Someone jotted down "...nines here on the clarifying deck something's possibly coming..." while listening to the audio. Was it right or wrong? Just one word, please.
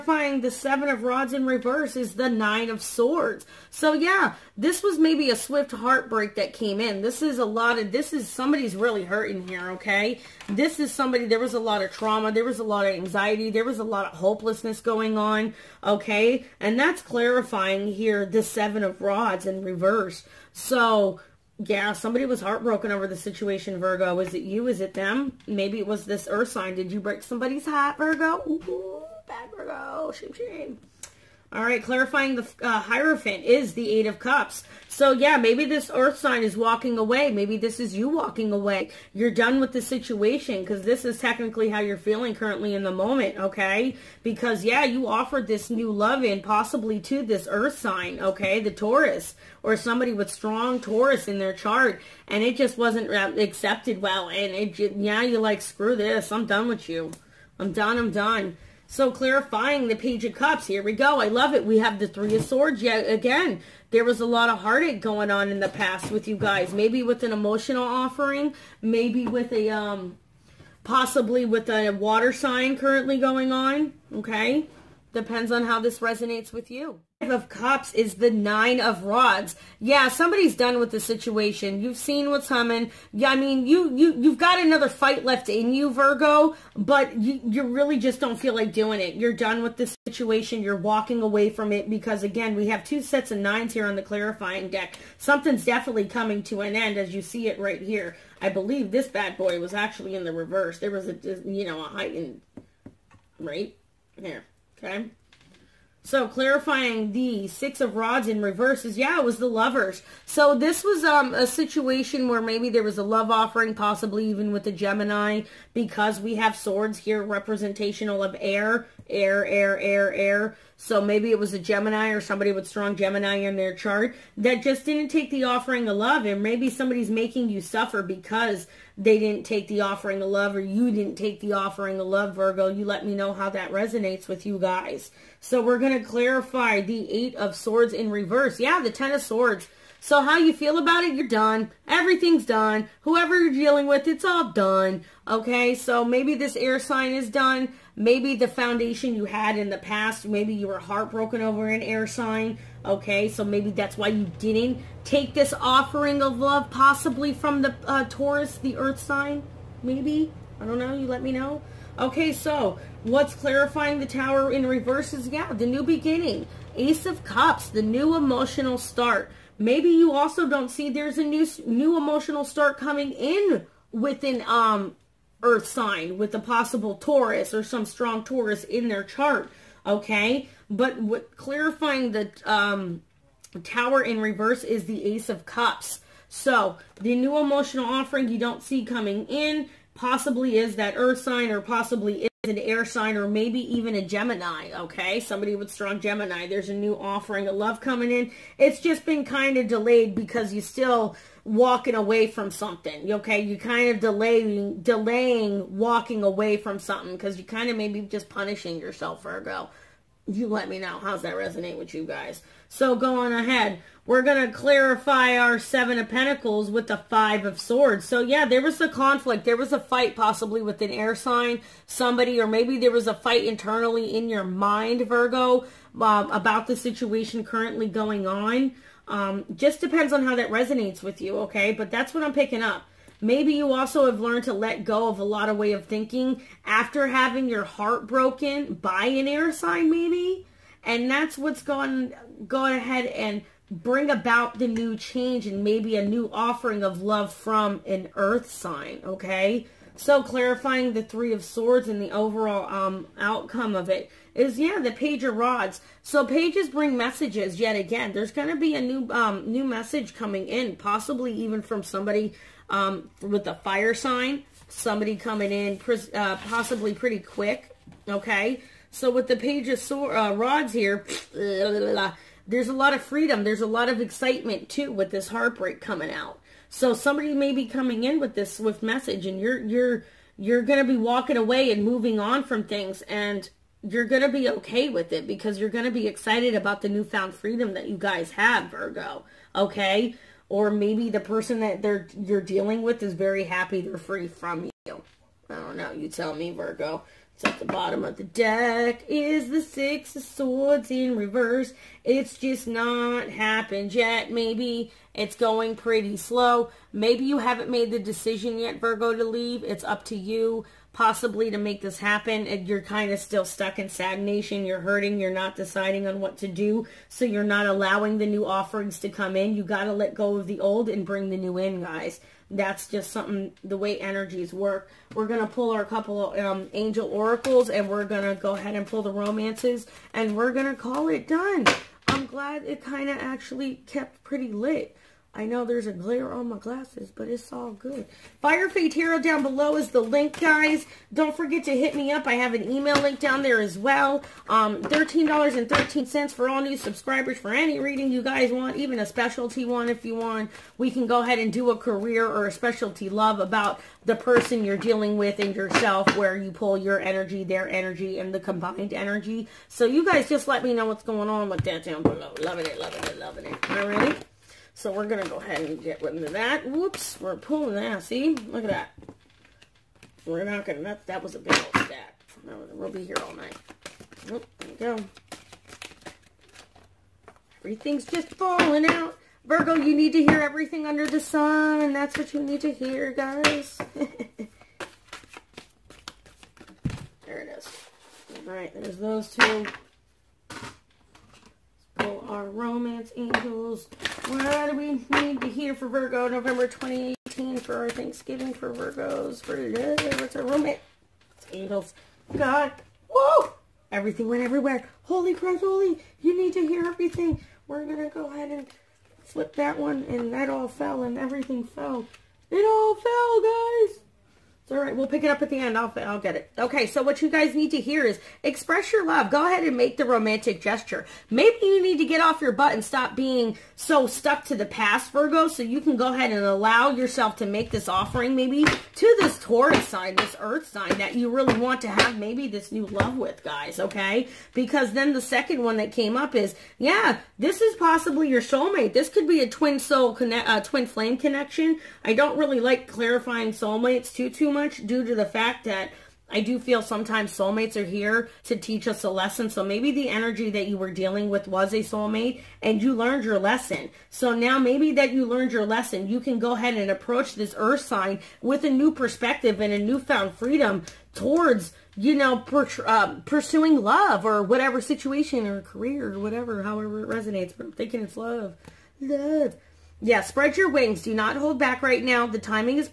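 wrong.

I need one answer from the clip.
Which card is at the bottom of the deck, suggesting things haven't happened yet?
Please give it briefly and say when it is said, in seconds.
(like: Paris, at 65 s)
Six of Swords, at 299 s.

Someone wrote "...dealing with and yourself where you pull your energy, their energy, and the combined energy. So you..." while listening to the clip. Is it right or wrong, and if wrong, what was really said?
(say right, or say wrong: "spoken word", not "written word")
right.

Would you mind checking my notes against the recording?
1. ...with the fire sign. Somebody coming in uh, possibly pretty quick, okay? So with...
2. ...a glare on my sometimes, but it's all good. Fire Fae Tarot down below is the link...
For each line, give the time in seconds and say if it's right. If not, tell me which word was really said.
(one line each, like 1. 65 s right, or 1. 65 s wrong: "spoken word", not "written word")
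1. 263 s right
2. 335 s wrong: "glasses", not "sometimes".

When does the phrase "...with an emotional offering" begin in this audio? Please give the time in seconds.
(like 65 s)
67 s.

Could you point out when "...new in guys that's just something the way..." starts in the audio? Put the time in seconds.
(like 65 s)
321 s.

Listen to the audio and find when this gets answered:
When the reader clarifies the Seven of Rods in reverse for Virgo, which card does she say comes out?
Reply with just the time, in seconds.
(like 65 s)
2 s.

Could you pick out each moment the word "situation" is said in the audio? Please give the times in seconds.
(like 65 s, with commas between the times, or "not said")
23 s, 39 s, 80 s, 90 s, 111 s, 226 s, 464 s.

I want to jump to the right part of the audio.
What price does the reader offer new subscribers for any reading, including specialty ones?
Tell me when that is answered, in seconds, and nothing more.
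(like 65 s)
344 s.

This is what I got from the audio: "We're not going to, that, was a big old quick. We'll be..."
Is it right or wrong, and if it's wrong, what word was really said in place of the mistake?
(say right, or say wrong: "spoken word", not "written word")
wrong: "stack", not "quick".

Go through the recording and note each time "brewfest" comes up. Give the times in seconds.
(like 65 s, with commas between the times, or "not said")
not said.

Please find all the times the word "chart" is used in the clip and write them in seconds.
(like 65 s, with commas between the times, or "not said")
51 s, 123 s, 179 s.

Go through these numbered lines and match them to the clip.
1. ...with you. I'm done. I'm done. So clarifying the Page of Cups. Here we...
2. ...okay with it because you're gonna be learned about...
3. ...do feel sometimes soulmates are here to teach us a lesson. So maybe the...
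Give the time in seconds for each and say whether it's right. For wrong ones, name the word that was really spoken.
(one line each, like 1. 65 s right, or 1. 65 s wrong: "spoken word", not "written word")
1. 56 s right
2. 284 s wrong: "excited", not "learned"
3. 446 s right.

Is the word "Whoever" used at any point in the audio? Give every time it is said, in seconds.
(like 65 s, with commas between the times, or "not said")
143 s.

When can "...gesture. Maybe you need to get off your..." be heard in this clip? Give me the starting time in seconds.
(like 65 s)
420 s.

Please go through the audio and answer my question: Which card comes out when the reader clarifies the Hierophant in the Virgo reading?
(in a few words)
Eight of Cups.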